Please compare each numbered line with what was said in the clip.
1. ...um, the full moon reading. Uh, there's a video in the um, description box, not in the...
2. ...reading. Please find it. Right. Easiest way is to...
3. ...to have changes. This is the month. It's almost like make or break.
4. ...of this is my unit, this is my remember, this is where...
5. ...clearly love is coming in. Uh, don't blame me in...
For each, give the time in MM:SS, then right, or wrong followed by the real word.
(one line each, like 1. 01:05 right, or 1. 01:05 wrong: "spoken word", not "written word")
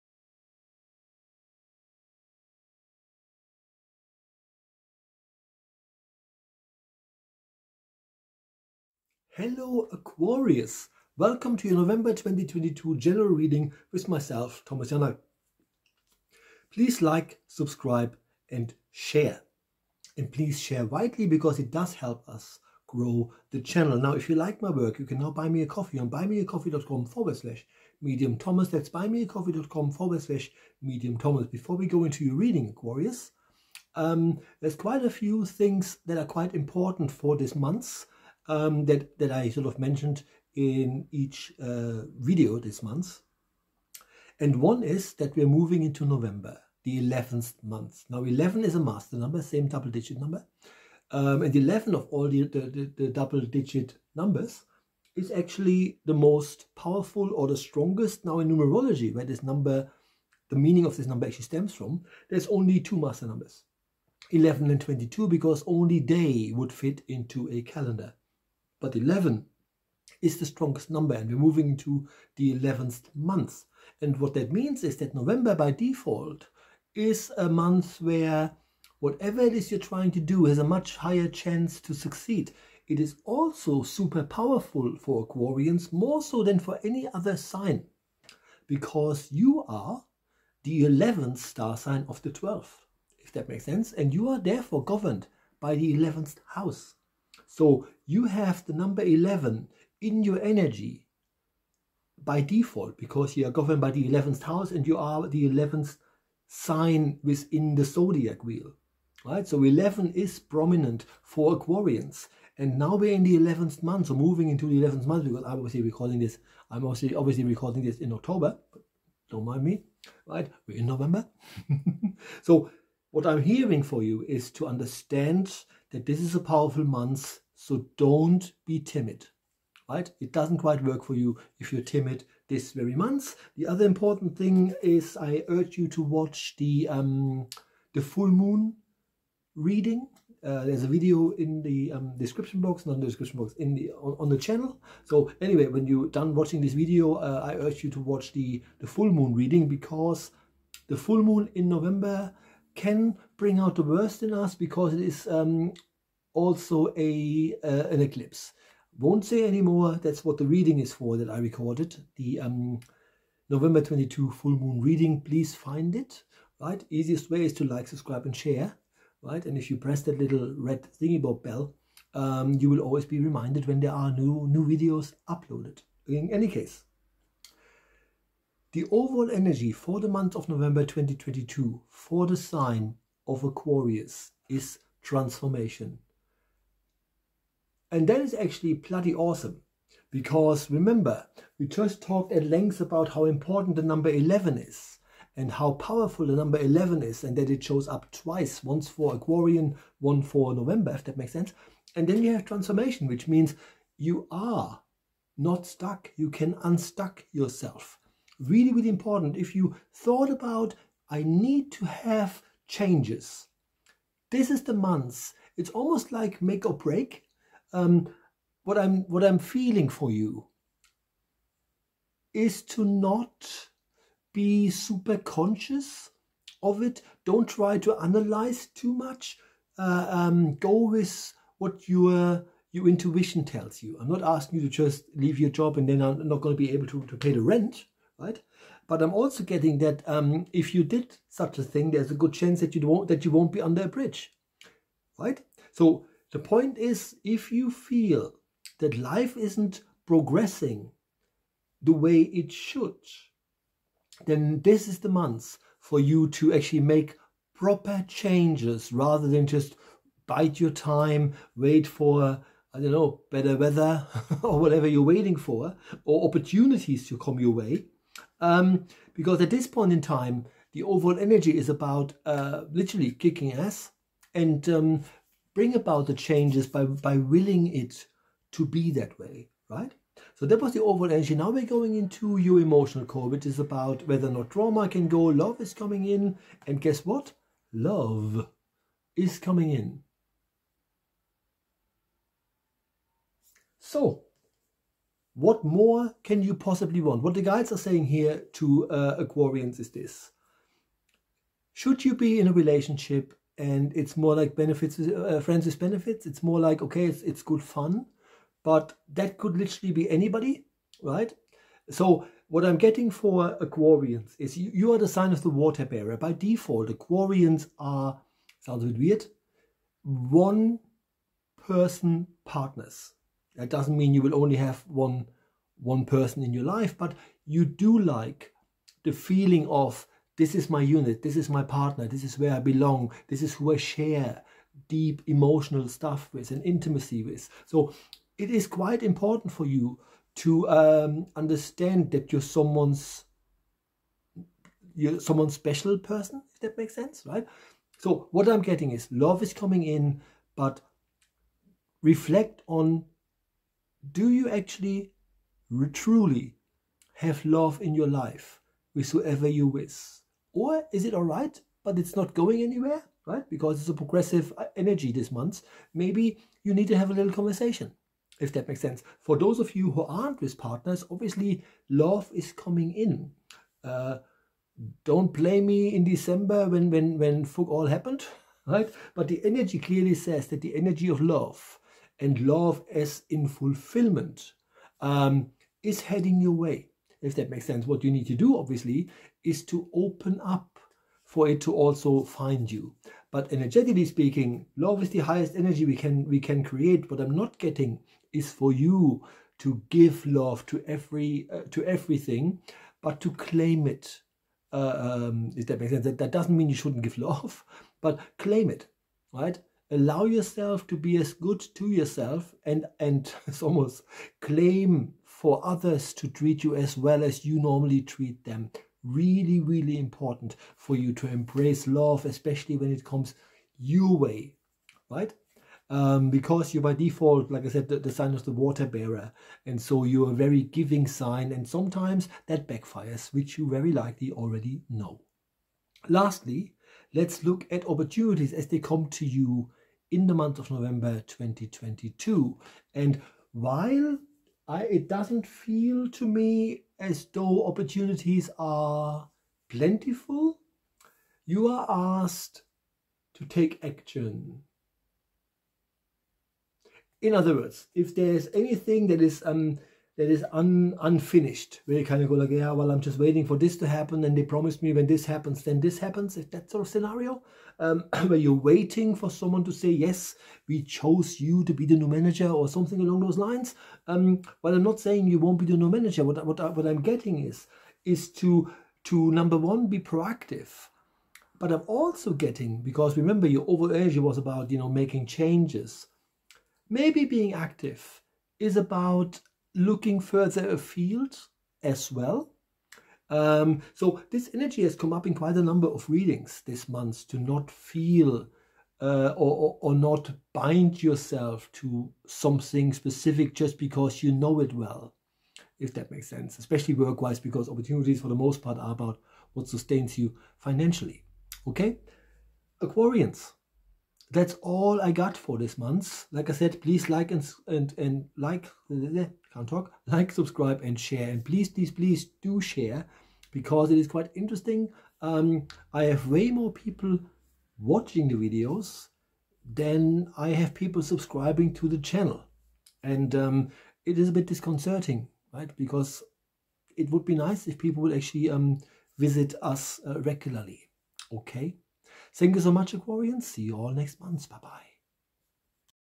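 1. 02:16 right
2. 02:44 right
3. 03:31 right
4. 05:29 wrong: "partner", not "remember"
5. 06:11 wrong: "obviously", not "clearly".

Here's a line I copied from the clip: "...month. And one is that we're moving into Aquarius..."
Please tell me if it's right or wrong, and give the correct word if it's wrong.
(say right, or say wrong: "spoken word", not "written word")
wrong: "November", not "Aquarius".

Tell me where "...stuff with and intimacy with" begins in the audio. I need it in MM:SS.
05:35.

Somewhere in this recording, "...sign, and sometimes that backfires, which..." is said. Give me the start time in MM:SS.
07:11.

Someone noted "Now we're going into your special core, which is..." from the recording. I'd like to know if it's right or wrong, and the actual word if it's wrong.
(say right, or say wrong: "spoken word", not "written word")
wrong: "emotional", not "special".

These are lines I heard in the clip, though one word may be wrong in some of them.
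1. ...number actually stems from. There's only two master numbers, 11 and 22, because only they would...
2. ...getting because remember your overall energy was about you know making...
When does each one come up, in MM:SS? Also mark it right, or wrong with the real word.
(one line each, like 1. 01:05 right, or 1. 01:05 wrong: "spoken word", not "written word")
1. 01:01 right
2. 08:02 right.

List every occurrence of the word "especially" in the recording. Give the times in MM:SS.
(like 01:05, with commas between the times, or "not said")
07:02, 08:26.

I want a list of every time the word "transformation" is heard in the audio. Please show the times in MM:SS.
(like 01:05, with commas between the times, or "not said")
03:05, 03:22.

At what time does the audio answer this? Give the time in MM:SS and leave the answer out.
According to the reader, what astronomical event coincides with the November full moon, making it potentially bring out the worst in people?
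02:37.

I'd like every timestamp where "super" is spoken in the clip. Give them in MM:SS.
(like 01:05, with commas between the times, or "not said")
01:23, 03:44.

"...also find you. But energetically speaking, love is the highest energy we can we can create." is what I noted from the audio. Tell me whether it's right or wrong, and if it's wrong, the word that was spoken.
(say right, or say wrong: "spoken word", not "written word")
right.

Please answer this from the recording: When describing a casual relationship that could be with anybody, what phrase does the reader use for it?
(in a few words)
Friends with benefits.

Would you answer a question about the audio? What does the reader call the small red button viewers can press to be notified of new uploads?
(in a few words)
Bell.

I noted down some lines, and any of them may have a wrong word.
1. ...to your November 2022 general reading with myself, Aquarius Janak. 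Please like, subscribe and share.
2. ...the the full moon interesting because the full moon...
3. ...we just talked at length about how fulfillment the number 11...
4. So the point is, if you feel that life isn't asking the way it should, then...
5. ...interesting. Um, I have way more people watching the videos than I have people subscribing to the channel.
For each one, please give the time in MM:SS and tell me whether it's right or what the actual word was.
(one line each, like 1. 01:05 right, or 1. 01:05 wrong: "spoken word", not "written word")
1. 00:11 wrong: "Thomas", not "Aquarius"
2. 02:28 wrong: "reading", not "interesting"
3. 03:11 wrong: "important", not "fulfillment"
4. 04:05 wrong: "progressing", not "asking"
5. 08:44 right.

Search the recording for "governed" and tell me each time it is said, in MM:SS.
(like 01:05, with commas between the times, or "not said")
01:34, 01:43.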